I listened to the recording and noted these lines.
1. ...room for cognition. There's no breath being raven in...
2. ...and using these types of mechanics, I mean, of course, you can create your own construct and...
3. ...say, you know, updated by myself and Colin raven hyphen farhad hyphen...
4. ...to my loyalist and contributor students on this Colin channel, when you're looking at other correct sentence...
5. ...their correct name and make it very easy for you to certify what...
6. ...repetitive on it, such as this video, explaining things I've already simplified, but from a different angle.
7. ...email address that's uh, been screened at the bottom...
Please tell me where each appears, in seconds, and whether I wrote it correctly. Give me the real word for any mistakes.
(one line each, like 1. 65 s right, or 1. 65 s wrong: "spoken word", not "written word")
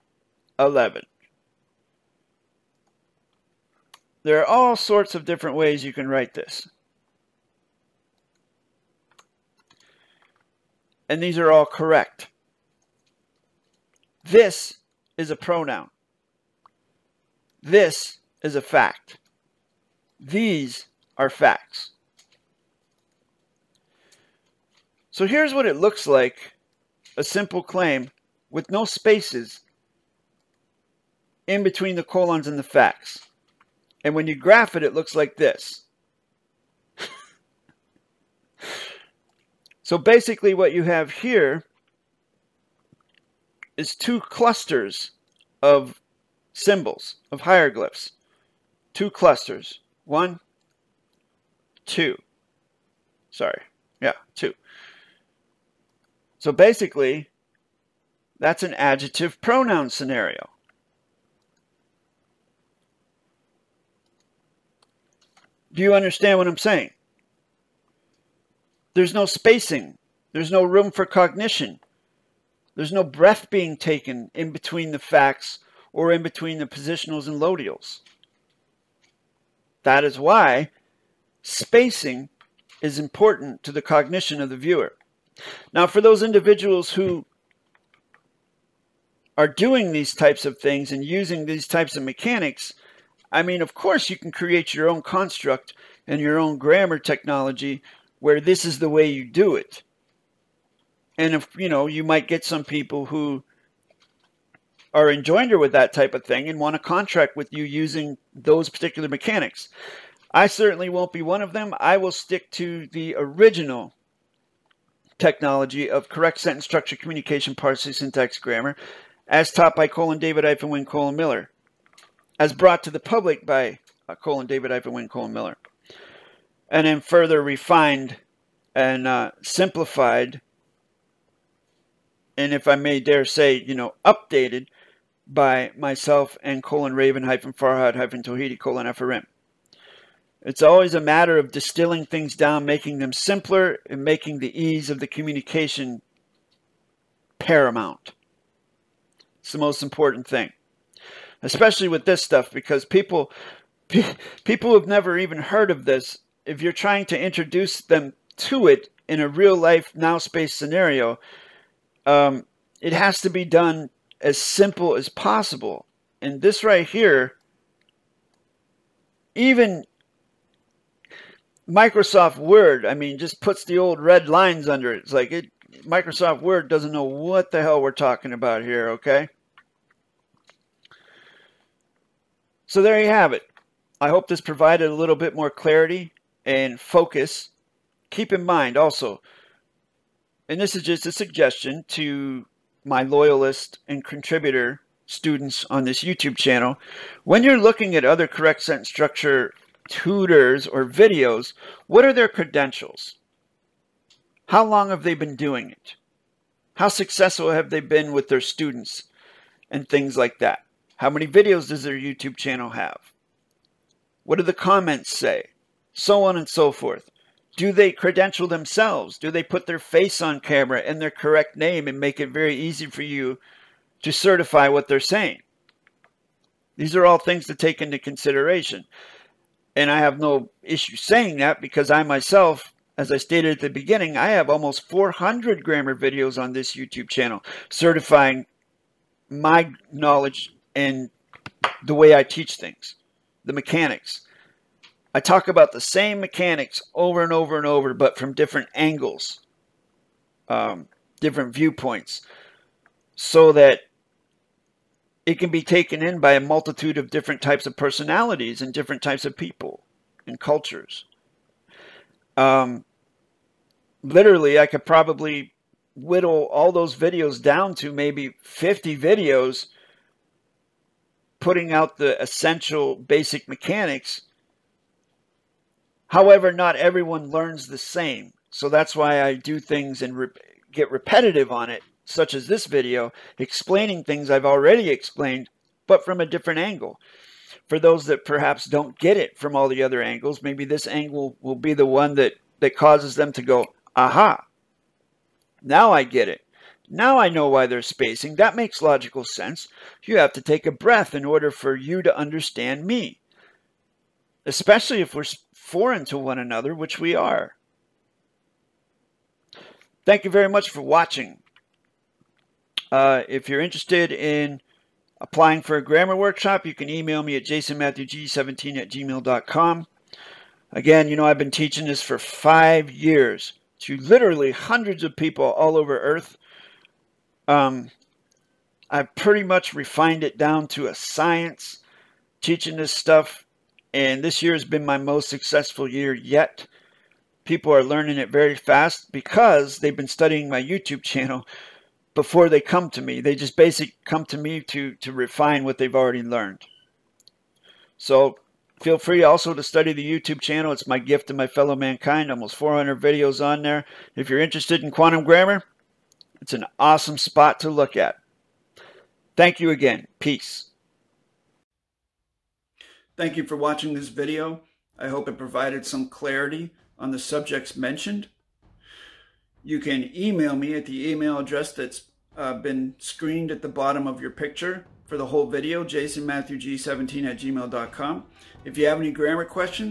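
1. 70 s wrong: "taken", not "raven"
2. 90 s right
3. 133 s right
4. 191 s wrong: "YouTube", not "Colin"
5. 220 s right
6. 280 s wrong: "explained", not "simplified"
7. 371 s right.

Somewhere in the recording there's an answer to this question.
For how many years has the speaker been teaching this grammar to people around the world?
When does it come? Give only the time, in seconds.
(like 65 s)
322 s.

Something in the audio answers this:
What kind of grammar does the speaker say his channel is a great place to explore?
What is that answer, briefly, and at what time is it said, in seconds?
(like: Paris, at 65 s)
quantum grammar, at 354 s.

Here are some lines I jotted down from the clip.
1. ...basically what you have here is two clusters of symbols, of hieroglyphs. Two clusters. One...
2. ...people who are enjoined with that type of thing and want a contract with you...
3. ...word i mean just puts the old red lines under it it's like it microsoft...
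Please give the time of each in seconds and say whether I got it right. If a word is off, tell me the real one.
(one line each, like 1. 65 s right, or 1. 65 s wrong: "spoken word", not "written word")
1. 39 s right
2. 102 s right
3. 172 s right.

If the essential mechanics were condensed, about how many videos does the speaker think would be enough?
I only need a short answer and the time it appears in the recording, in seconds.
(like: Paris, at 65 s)
50, at 268 s.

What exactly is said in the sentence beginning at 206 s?
How successful have they been with their students and things like that?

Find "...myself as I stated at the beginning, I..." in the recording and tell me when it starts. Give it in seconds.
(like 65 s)
232 s.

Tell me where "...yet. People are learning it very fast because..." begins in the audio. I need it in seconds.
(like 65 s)
336 s.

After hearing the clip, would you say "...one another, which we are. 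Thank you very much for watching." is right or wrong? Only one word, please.
right.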